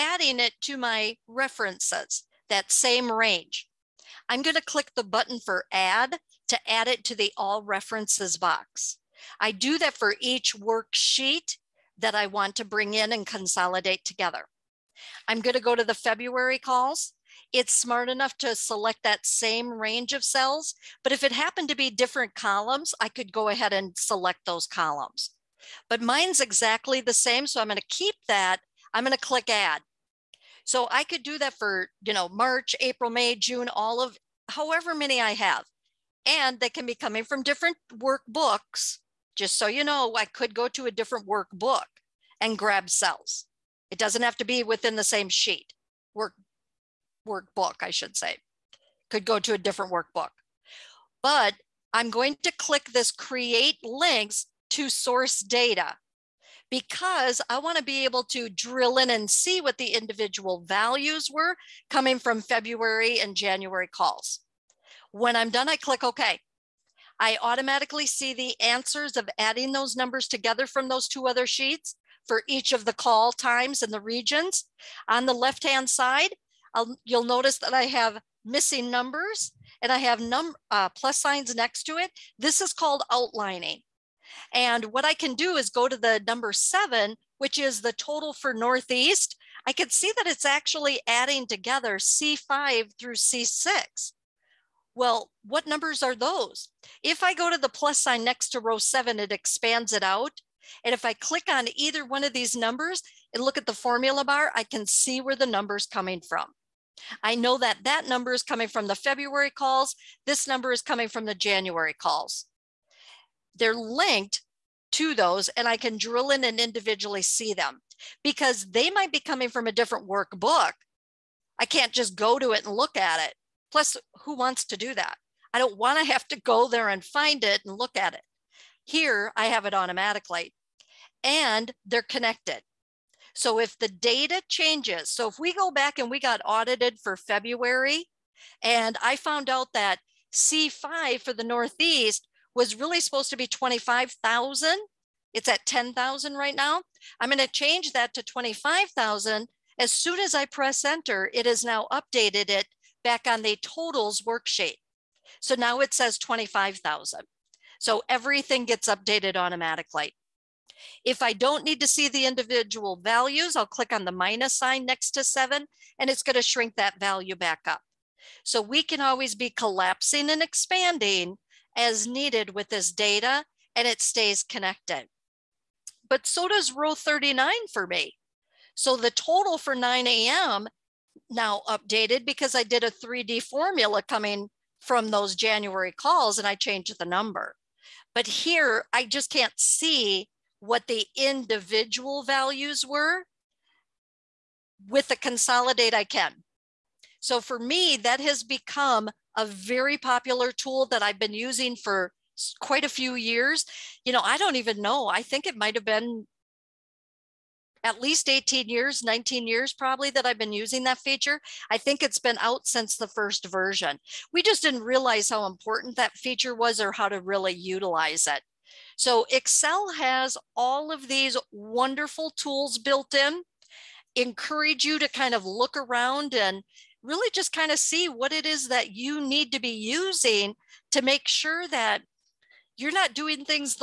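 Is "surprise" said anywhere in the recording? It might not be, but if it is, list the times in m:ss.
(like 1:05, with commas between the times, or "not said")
not said.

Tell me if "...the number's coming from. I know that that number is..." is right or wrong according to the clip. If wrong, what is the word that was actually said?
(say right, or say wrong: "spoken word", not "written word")
right.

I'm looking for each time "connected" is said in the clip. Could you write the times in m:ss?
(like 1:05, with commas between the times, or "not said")
2:12, 2:54.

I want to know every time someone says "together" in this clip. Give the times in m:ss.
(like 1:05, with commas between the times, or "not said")
0:14, 1:10, 1:31.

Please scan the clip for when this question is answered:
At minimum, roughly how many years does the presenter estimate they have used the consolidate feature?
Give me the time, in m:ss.
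3:28.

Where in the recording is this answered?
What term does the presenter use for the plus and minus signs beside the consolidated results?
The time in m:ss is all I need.
1:23.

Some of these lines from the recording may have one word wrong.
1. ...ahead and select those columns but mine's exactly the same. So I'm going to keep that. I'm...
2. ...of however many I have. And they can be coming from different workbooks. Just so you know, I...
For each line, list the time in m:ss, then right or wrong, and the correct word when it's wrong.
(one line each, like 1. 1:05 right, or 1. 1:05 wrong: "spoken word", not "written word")
1. 0:23 right
2. 0:33 right.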